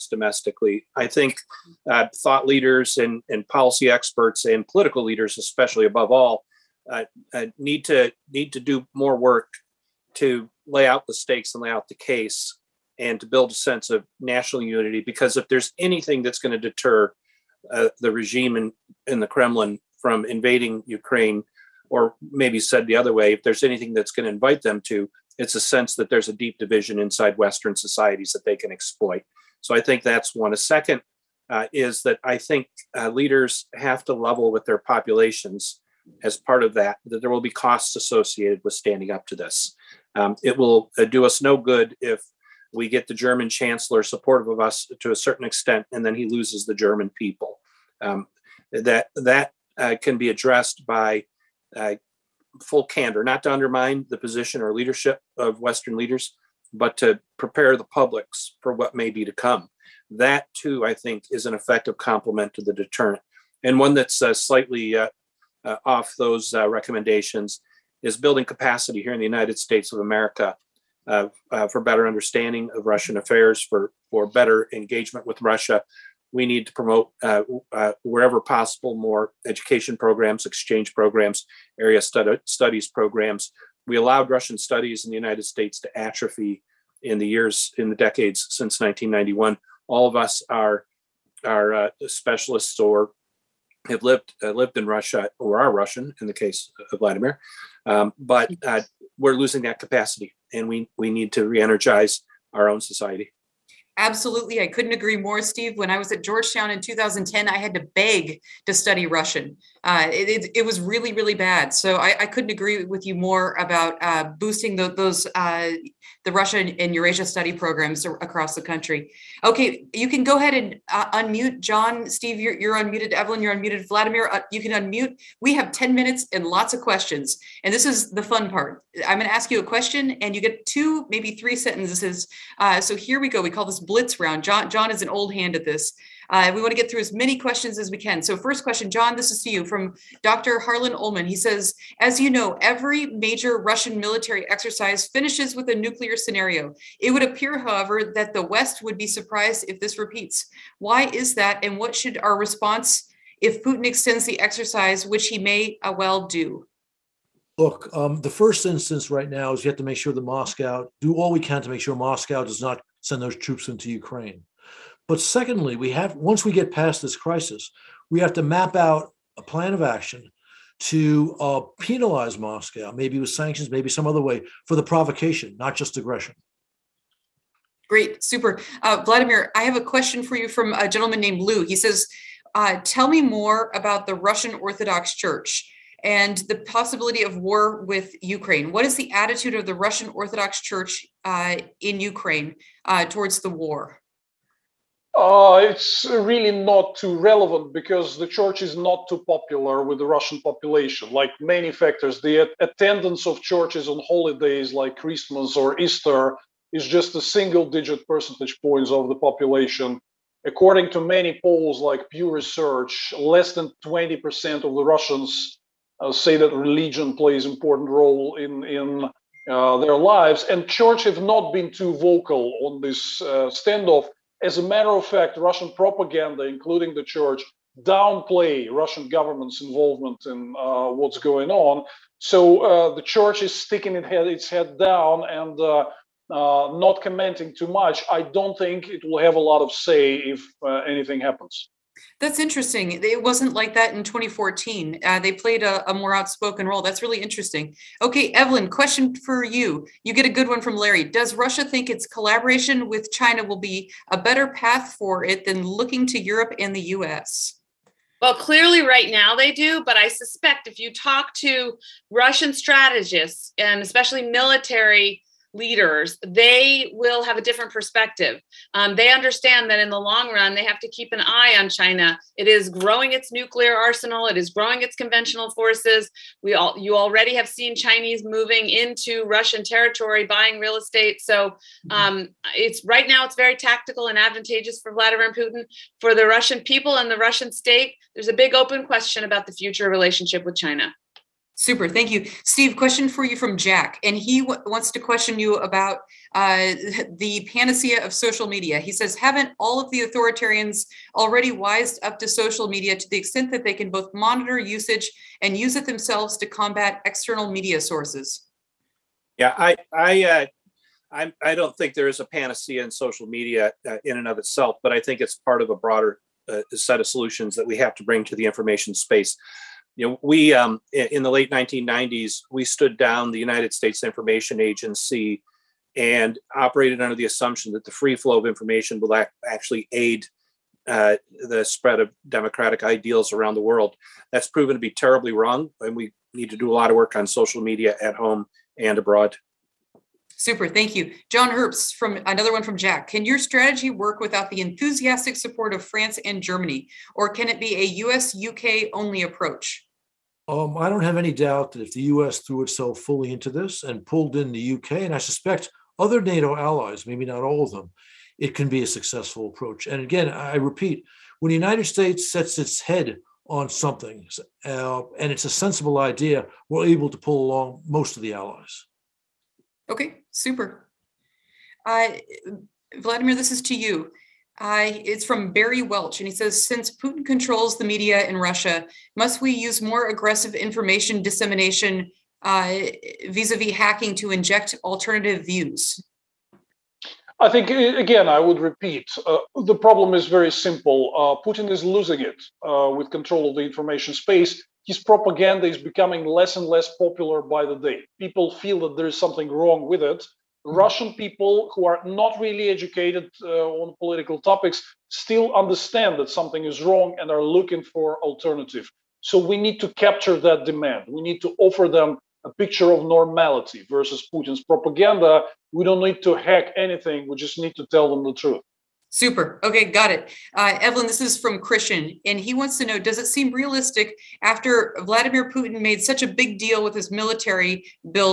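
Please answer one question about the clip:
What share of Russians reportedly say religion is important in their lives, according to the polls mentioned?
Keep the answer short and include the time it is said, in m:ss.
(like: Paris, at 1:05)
less than 20%, at 3:33.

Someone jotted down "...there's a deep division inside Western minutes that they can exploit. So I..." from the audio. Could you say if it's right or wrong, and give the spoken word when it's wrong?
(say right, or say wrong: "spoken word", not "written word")
wrong: "societies", not "minutes".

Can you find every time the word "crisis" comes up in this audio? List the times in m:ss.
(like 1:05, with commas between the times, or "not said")
2:47.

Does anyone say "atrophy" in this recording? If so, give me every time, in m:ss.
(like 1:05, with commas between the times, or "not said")
1:25.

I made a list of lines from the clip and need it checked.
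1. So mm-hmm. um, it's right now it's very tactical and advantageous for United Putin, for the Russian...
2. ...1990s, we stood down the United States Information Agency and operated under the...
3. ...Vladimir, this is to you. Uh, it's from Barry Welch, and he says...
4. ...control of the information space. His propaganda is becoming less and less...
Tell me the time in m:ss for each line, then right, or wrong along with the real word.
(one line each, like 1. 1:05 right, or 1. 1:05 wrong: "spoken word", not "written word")
1. 4:41 wrong: "Vladimir", not "United"
2. 5:21 right
3. 6:12 right
4. 6:33 right.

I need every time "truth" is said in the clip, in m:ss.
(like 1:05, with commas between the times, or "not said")
6:58.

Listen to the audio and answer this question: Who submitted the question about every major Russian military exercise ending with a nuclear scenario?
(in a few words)
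Dr. Harlan Ullman.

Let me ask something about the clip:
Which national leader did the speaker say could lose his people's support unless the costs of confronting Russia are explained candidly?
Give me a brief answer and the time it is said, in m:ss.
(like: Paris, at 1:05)
German chancellor, at 0:43.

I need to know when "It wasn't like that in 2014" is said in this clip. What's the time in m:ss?
4:03.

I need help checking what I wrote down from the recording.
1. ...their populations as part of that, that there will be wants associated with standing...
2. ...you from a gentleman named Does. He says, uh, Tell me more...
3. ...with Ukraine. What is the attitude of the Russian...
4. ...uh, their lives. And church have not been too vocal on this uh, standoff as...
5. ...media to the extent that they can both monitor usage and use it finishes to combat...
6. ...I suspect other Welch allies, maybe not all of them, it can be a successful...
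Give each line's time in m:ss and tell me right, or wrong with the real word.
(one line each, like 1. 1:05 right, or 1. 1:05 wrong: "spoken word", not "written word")
1. 0:34 wrong: "costs", not "wants"
2. 3:00 wrong: "Lou", not "Does"
3. 3:07 right
4. 3:39 right
5. 5:02 wrong: "themselves", not "finishes"
6. 5:55 wrong: "NATO", not "Welch".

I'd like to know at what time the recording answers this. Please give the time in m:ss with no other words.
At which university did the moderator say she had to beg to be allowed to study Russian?
1:46.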